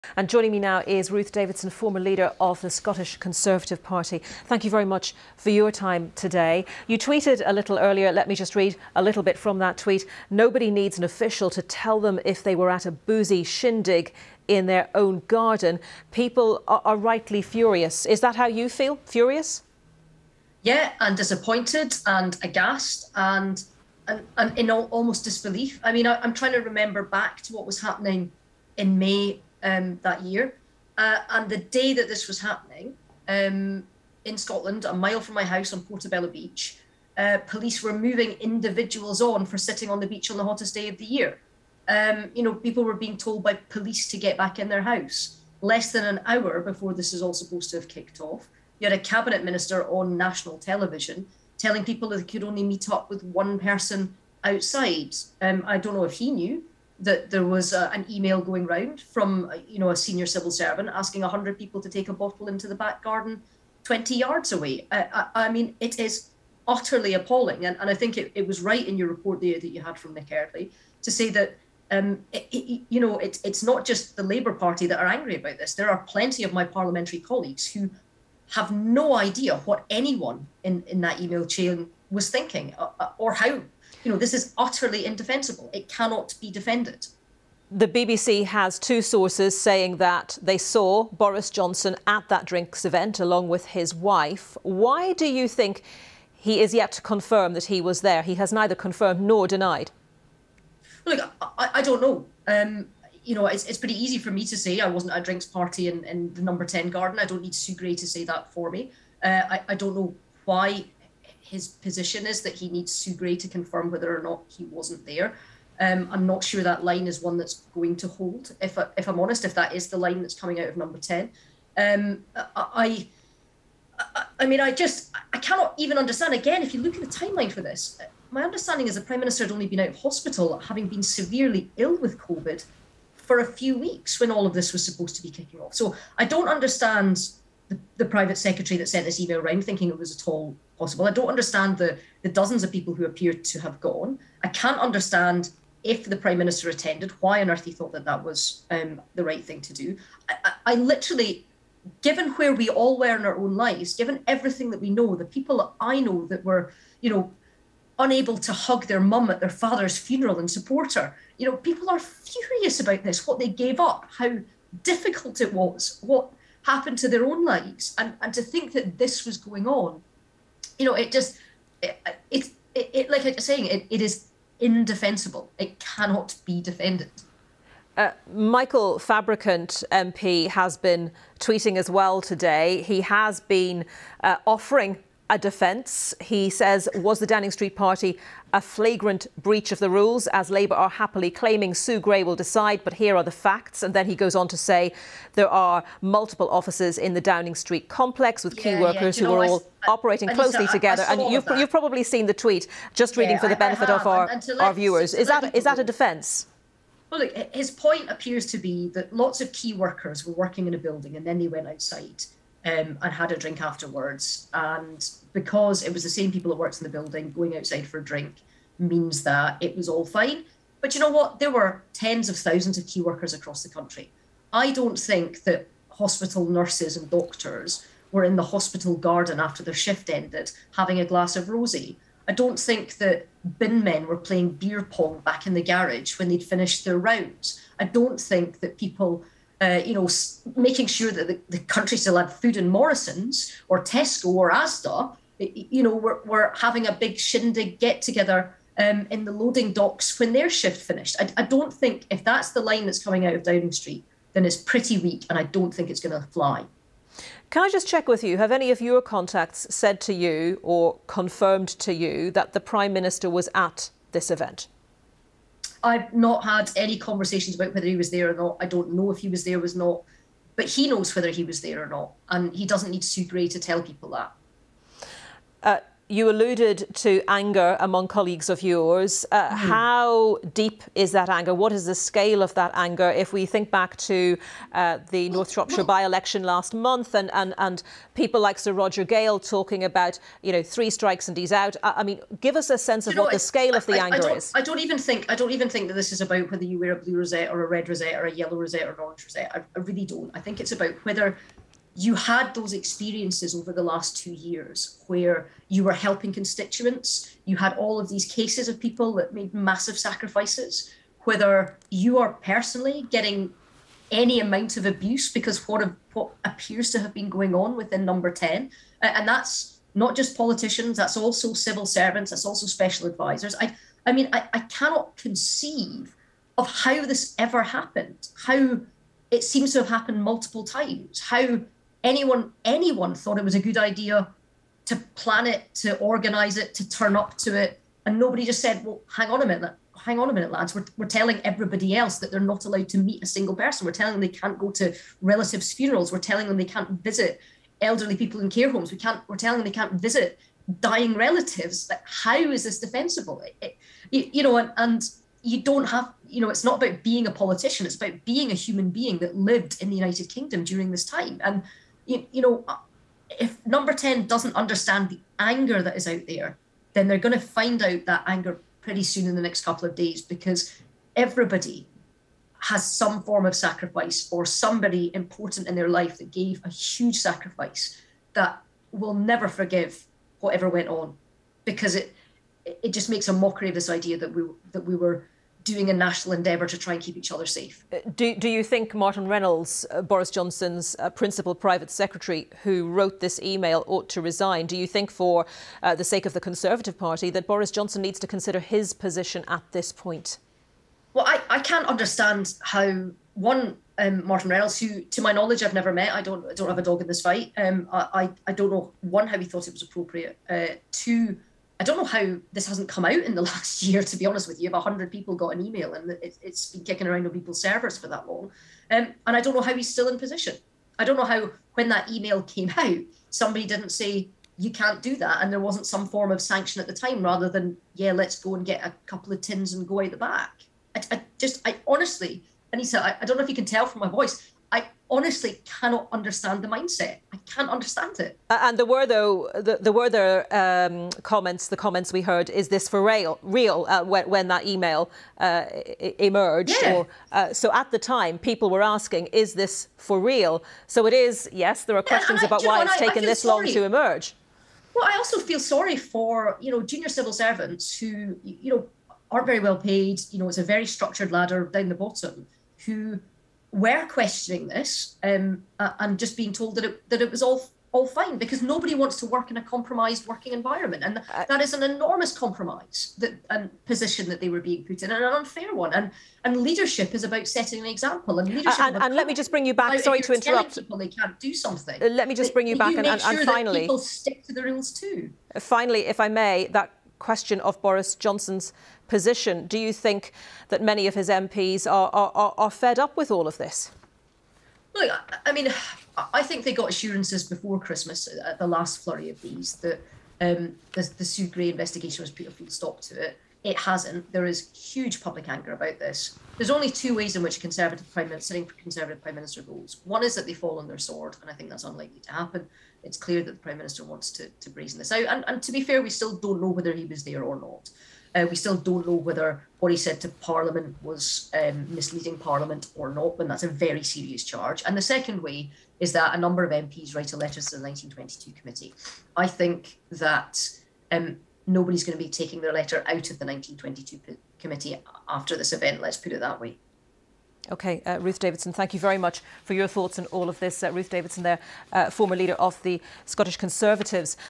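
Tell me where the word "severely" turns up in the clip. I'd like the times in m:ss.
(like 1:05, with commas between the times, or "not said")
2:11.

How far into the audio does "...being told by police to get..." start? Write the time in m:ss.
0:42.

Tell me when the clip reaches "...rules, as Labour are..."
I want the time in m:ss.
3:09.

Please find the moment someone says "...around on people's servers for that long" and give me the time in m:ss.
6:57.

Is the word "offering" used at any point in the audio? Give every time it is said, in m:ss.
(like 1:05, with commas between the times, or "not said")
3:04.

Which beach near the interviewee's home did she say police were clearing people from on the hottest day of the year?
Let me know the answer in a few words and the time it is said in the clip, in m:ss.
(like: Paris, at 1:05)
Portobello Beach, at 0:35.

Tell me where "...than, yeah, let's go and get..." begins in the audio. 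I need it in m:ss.
7:07.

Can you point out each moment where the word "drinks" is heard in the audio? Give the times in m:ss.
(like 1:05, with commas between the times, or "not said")
1:32, 1:45, 3:33, 3:38.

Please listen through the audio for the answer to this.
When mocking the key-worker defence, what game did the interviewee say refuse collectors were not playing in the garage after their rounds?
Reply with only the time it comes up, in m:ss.
3:54.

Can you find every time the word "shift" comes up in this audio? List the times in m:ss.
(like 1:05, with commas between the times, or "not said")
3:49, 4:10.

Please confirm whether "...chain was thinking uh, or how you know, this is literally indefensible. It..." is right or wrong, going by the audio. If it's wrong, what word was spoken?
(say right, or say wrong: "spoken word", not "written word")
wrong: "utterly", not "literally".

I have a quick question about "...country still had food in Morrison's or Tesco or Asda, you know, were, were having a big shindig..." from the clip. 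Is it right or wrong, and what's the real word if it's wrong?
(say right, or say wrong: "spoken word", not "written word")
right.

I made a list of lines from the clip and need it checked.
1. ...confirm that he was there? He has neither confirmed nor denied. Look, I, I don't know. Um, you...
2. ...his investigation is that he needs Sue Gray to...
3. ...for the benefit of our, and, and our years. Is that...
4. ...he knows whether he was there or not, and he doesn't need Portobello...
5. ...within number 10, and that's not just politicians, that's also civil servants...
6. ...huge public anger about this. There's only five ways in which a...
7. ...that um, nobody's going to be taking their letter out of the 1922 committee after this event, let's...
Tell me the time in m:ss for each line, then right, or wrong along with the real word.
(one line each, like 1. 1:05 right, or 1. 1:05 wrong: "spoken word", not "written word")
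1. 1:37 right
2. 1:51 wrong: "position", not "investigation"
3. 3:23 wrong: "viewers", not "years"
4. 4:30 wrong: "Sue", not "Portobello"
5. 5:17 right
6. 8:24 wrong: "two", not "five"
7. 8:50 right.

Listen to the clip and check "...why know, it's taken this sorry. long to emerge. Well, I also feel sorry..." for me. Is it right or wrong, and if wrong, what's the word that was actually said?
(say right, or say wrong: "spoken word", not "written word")
right.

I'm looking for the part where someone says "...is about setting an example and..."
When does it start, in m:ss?
7:57.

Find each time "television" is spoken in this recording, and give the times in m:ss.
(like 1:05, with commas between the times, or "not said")
0:50.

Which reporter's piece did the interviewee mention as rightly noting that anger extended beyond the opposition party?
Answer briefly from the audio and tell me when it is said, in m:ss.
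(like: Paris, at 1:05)
Nick Eardley, at 1:10.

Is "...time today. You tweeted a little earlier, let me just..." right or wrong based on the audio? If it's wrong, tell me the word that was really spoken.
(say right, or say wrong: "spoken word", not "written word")
right.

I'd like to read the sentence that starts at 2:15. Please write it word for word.
So I don't understand the, the private secretary that sent this email around thinking it was at all possible.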